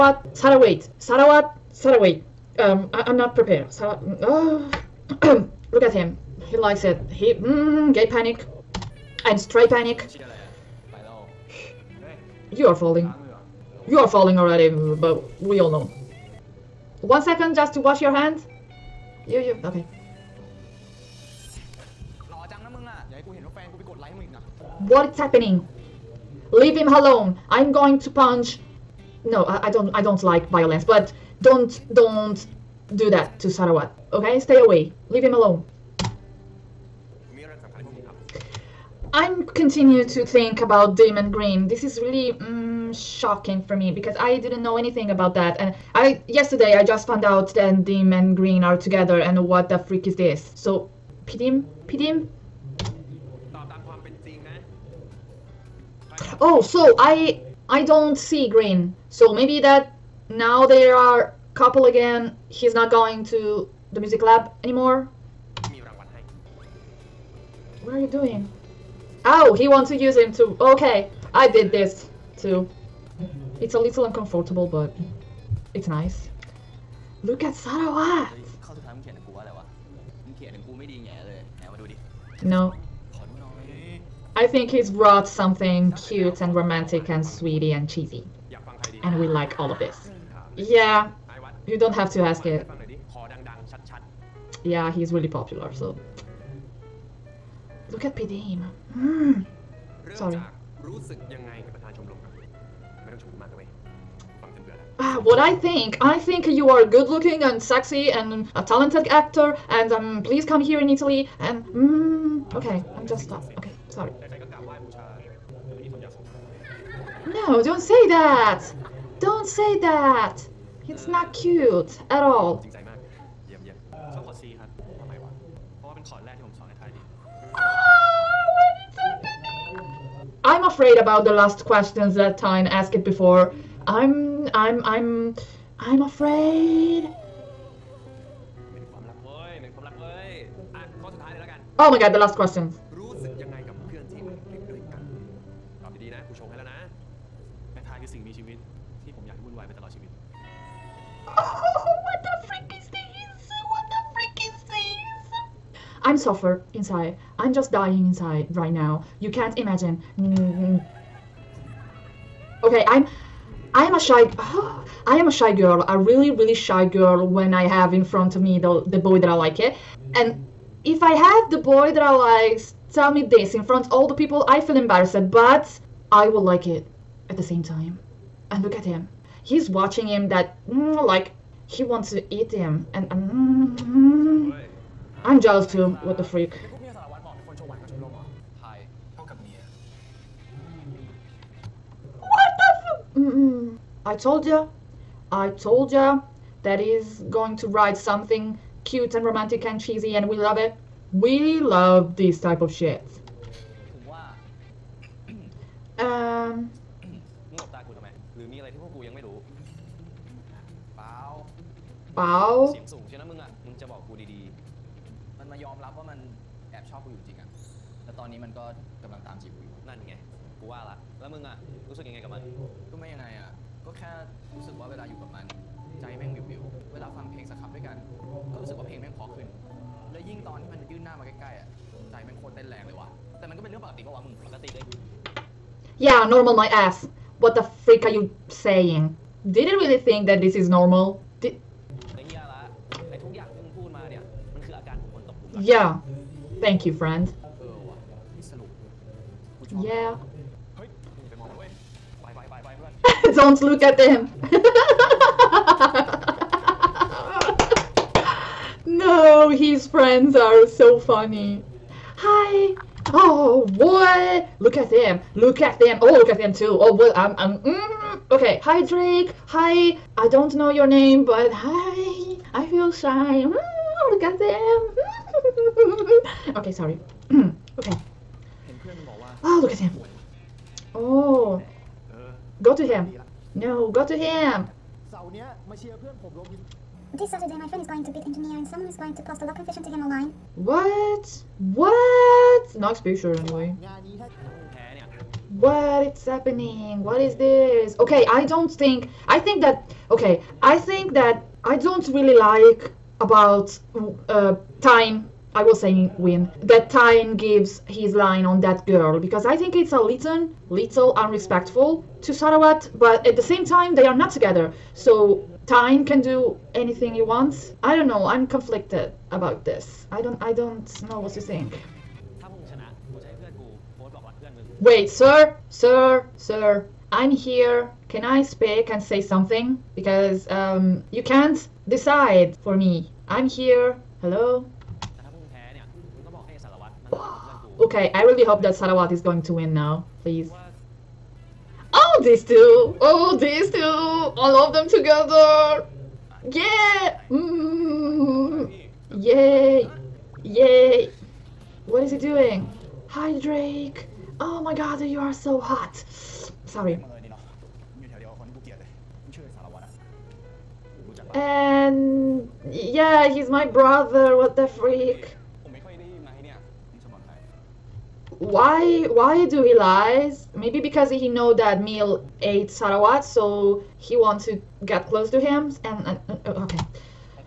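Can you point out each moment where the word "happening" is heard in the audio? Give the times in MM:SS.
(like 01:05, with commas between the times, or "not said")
00:25, 04:56.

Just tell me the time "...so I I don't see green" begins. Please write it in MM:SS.
00:56.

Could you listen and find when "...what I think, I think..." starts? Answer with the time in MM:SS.
01:45.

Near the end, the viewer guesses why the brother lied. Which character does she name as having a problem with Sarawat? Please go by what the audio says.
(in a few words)
Mil.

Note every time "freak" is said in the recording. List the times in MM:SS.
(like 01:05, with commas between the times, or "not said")
00:49, 03:06, 03:57, 06:04.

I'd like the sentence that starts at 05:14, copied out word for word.
So Tine can do anything he wants.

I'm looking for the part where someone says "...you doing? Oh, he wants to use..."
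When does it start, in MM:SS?
01:07.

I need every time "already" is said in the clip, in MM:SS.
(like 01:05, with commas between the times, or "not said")
00:14.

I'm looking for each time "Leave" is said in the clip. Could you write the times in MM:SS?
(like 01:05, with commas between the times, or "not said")
00:26, 00:35.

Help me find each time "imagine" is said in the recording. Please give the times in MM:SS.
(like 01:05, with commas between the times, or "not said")
02:39.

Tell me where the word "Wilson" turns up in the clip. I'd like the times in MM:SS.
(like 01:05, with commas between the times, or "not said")
not said.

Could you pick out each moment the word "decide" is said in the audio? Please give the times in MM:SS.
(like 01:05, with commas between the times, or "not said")
05:31.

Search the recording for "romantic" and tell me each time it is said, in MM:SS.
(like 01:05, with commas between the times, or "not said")
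01:26, 03:19.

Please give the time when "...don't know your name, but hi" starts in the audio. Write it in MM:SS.
04:30.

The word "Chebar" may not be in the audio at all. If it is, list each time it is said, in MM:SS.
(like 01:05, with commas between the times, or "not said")
not said.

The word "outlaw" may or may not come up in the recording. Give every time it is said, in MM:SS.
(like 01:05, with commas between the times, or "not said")
not said.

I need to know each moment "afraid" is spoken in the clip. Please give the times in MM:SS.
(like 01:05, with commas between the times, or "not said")
02:10, 02:16.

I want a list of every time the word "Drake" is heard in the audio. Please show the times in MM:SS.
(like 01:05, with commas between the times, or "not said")
04:28, 05:53.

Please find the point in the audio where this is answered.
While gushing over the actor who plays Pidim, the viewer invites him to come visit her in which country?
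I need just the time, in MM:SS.
01:50.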